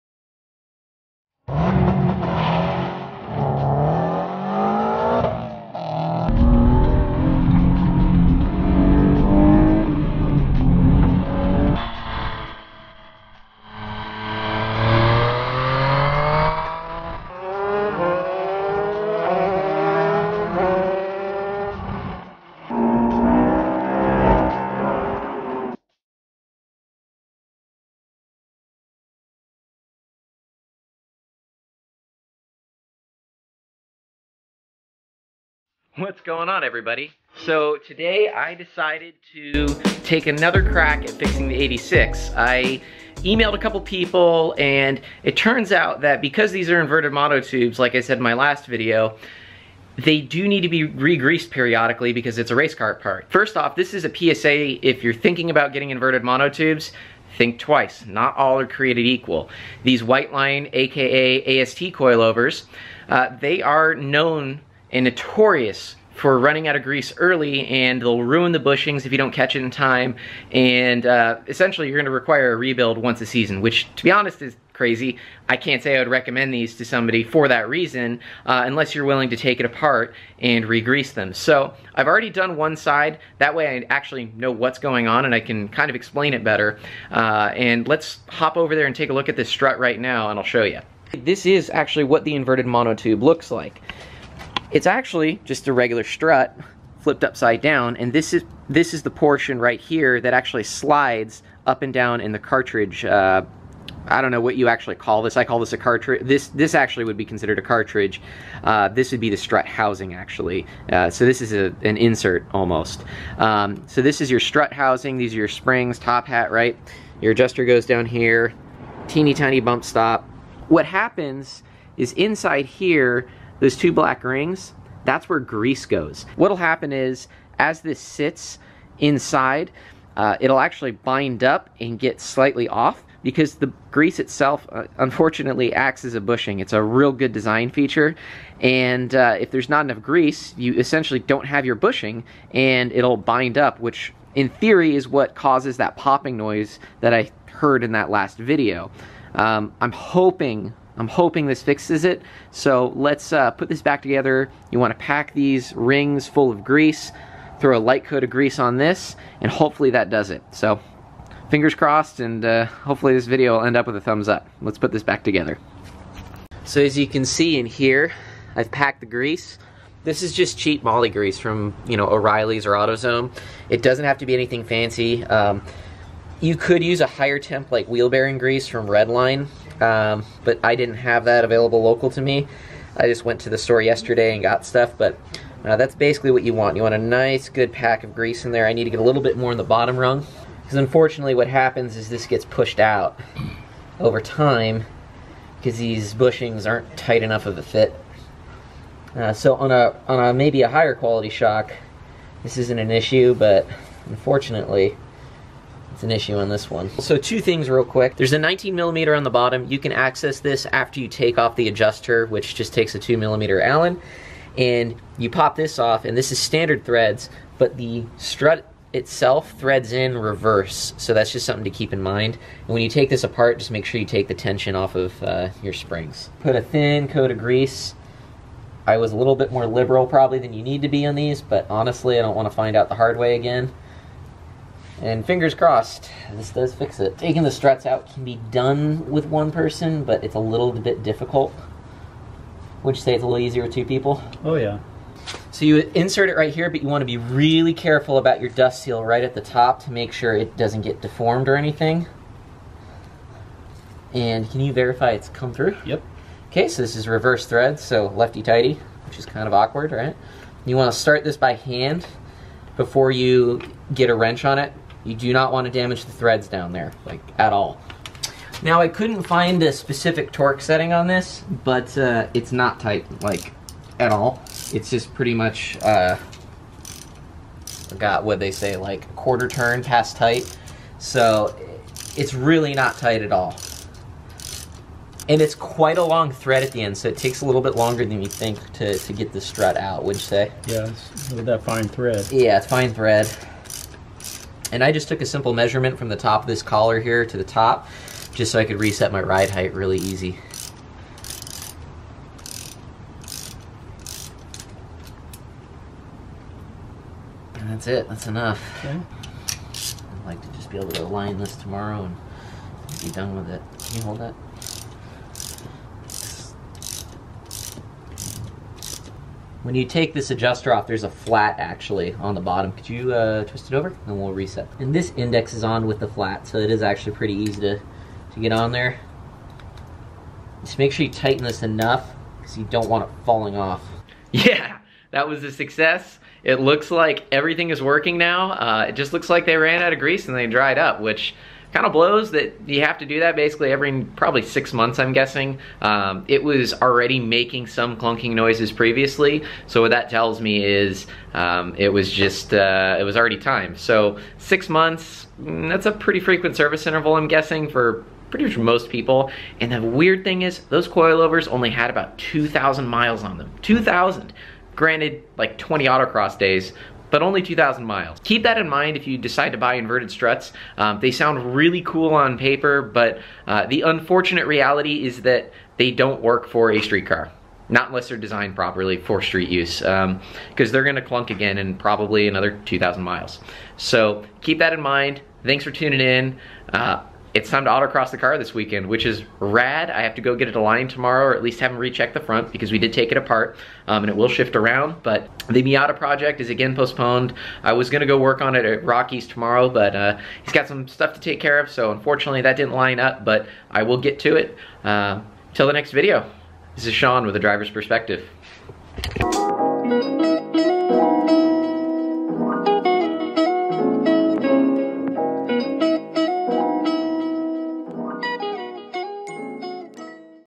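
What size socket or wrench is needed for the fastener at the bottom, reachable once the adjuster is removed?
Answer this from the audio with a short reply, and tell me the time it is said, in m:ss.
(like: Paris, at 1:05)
19 millimeter, at 3:28.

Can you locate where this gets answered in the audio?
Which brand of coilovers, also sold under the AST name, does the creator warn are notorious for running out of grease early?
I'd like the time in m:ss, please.
1:00.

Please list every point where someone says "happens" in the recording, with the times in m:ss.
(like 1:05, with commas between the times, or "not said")
2:00, 2:06, 3:11.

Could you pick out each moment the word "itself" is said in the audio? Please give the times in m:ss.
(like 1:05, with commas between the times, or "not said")
2:14, 3:38.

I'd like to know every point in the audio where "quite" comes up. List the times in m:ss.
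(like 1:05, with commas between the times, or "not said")
4:45.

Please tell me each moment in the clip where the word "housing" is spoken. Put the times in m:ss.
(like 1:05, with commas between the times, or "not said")
1:49, 1:54.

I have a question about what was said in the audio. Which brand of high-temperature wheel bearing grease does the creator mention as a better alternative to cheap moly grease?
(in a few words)
Redline.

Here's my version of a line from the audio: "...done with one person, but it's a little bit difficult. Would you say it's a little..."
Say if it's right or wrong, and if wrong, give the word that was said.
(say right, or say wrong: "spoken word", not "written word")
right.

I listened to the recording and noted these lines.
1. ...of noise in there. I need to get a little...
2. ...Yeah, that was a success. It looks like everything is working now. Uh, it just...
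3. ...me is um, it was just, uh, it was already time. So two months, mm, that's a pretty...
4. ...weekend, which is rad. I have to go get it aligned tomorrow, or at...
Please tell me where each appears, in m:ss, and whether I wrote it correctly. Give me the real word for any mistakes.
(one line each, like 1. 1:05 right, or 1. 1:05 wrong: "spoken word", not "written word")
1. 3:08 wrong: "grease", not "noise"
2. 5:34 right
3. 5:50 wrong: "six", not "two"
4. 6:28 right.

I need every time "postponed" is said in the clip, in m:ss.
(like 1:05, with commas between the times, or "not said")
6:36.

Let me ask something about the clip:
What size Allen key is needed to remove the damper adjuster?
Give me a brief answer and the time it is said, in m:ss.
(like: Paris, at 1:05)
2 millimeter, at 3:32.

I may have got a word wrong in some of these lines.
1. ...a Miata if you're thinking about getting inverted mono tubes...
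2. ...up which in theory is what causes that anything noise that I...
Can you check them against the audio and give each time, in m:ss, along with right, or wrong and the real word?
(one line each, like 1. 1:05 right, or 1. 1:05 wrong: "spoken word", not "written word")
1. 0:54 wrong: "PSA", not "Miata"
2. 2:23 wrong: "popping", not "anything".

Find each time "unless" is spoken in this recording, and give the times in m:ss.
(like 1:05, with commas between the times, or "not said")
1:18, 6:17.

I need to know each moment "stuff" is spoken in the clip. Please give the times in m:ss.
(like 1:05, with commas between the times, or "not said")
3:04, 6:40.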